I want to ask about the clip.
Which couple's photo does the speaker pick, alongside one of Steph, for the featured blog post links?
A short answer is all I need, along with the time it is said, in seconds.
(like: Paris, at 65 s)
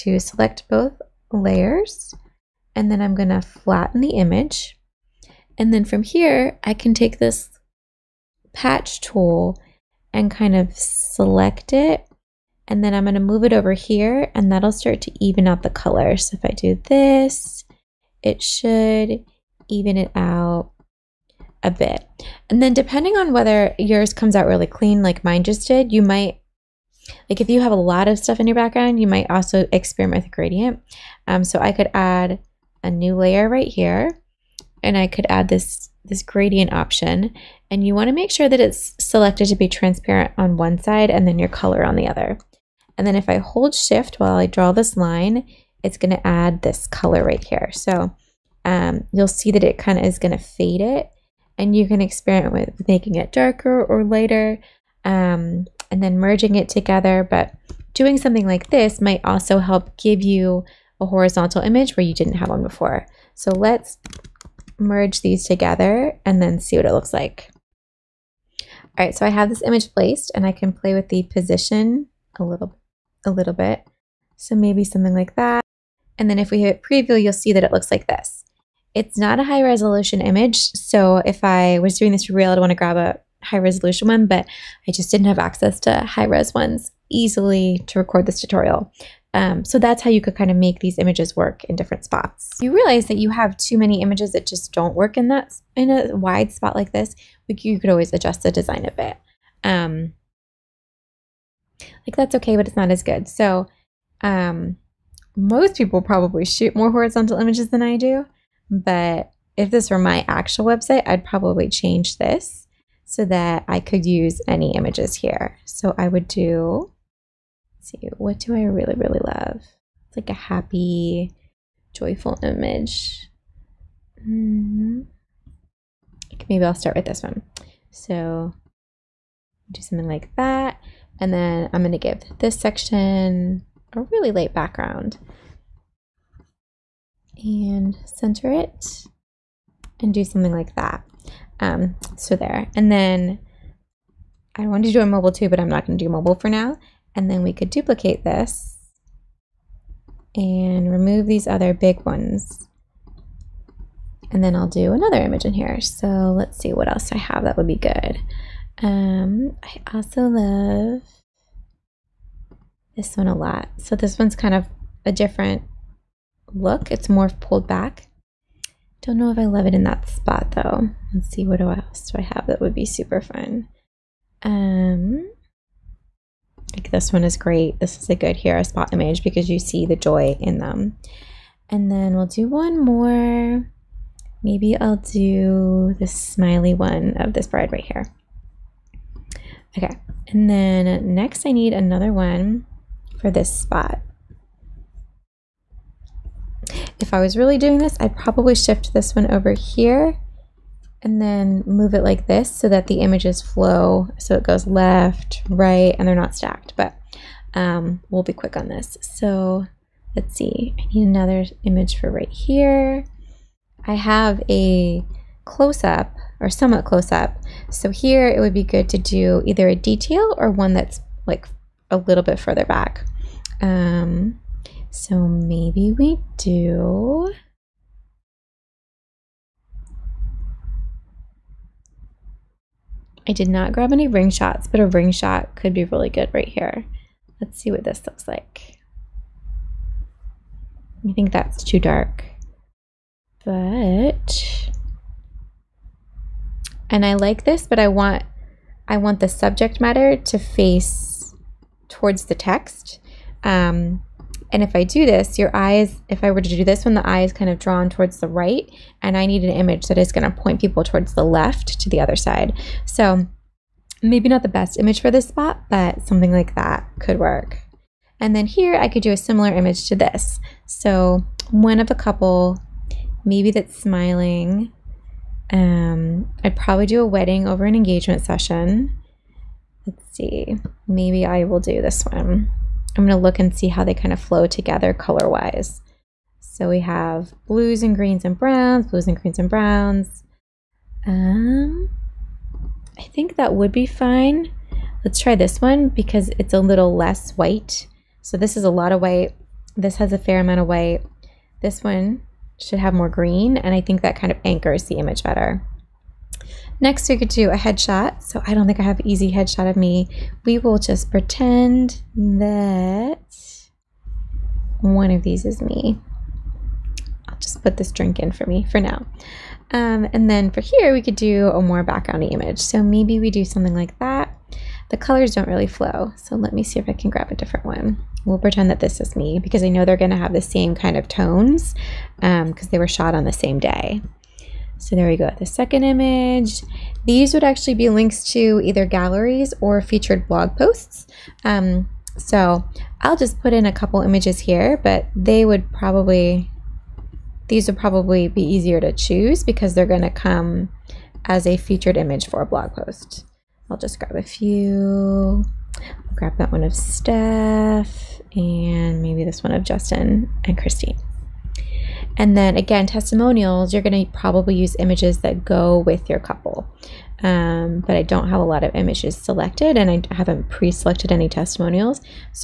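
Justin and Christine, at 359 s.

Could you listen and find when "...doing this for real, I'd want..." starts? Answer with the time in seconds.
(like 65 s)
81 s.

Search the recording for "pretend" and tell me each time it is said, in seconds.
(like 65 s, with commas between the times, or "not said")
311 s, 328 s.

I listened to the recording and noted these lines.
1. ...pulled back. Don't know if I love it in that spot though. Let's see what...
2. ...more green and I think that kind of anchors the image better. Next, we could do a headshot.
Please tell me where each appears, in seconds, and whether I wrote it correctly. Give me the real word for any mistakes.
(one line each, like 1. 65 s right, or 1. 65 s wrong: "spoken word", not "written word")
1. 167 s right
2. 302 s right.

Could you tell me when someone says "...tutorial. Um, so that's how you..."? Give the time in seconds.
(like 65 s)
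88 s.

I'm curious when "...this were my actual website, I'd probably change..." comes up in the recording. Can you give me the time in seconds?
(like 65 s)
109 s.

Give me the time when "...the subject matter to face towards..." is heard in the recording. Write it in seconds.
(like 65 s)
249 s.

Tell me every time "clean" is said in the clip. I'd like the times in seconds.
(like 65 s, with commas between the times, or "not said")
24 s.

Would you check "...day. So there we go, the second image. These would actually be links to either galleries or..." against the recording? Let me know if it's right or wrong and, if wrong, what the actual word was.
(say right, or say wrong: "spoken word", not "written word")
right.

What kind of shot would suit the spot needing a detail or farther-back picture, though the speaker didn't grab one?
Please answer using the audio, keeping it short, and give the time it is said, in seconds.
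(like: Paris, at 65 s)
ring shots, at 234 s.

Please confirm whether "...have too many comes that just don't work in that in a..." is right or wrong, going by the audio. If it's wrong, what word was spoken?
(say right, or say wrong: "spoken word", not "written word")
wrong: "images", not "comes".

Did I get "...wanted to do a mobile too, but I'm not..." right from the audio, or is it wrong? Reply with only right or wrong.
right.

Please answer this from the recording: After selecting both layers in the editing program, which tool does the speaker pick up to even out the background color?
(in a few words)
patch tool.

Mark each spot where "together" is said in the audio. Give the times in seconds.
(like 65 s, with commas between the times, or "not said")
56 s, 65 s, 284 s.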